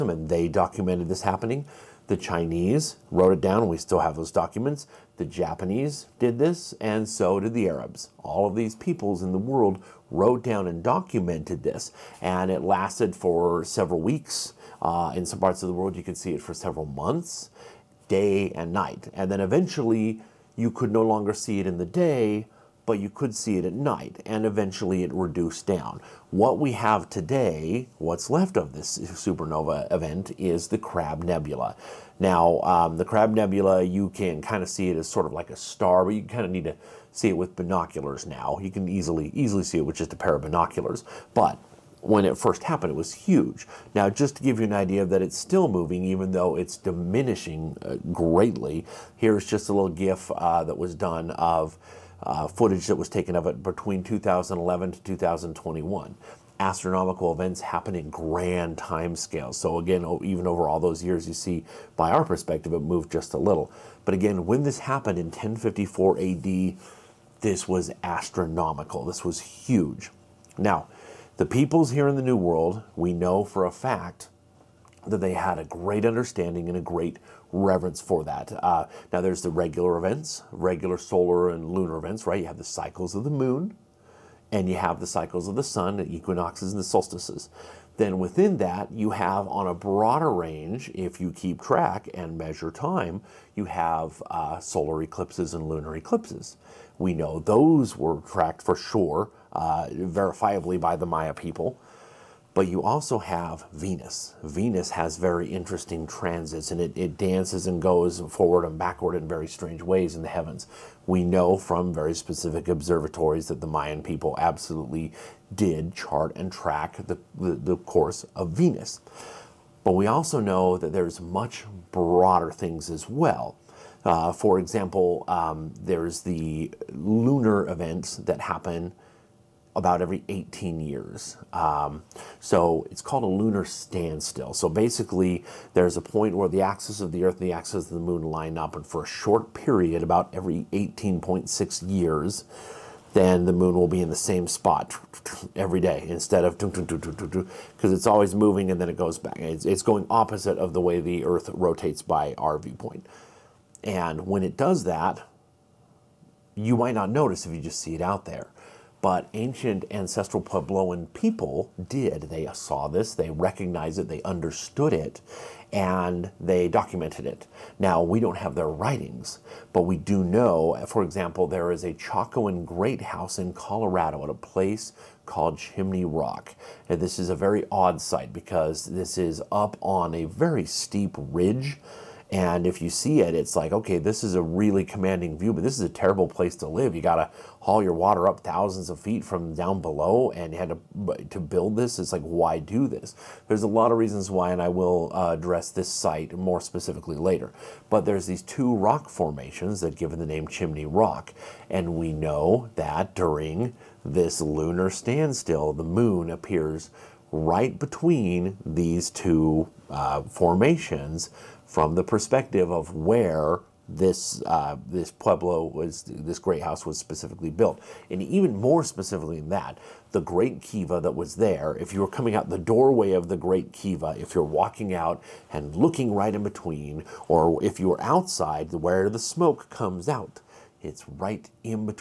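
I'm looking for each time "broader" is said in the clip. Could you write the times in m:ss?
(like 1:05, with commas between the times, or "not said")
1:29, 2:01.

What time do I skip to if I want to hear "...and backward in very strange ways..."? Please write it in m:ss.
1:48.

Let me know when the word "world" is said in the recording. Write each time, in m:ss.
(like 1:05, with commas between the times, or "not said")
0:09, 0:15, 1:12.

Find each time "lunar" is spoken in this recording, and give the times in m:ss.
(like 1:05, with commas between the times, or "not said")
1:21, 1:35, 2:06, 2:13, 3:24.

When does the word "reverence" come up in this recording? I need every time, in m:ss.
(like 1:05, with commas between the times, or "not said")
1:17.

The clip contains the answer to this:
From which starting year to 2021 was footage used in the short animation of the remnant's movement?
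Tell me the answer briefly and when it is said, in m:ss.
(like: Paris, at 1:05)
2011, at 0:54.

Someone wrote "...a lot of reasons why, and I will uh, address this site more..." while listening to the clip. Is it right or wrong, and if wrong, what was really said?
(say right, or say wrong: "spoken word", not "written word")
right.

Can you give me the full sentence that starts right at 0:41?
But when it first happened, it was huge.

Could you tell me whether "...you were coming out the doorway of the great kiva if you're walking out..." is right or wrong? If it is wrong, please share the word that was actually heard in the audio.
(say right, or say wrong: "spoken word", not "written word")
right.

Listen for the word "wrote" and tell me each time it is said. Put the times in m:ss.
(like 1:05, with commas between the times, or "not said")
0:03, 0:10.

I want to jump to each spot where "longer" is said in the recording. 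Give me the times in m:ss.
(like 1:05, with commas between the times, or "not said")
0:21.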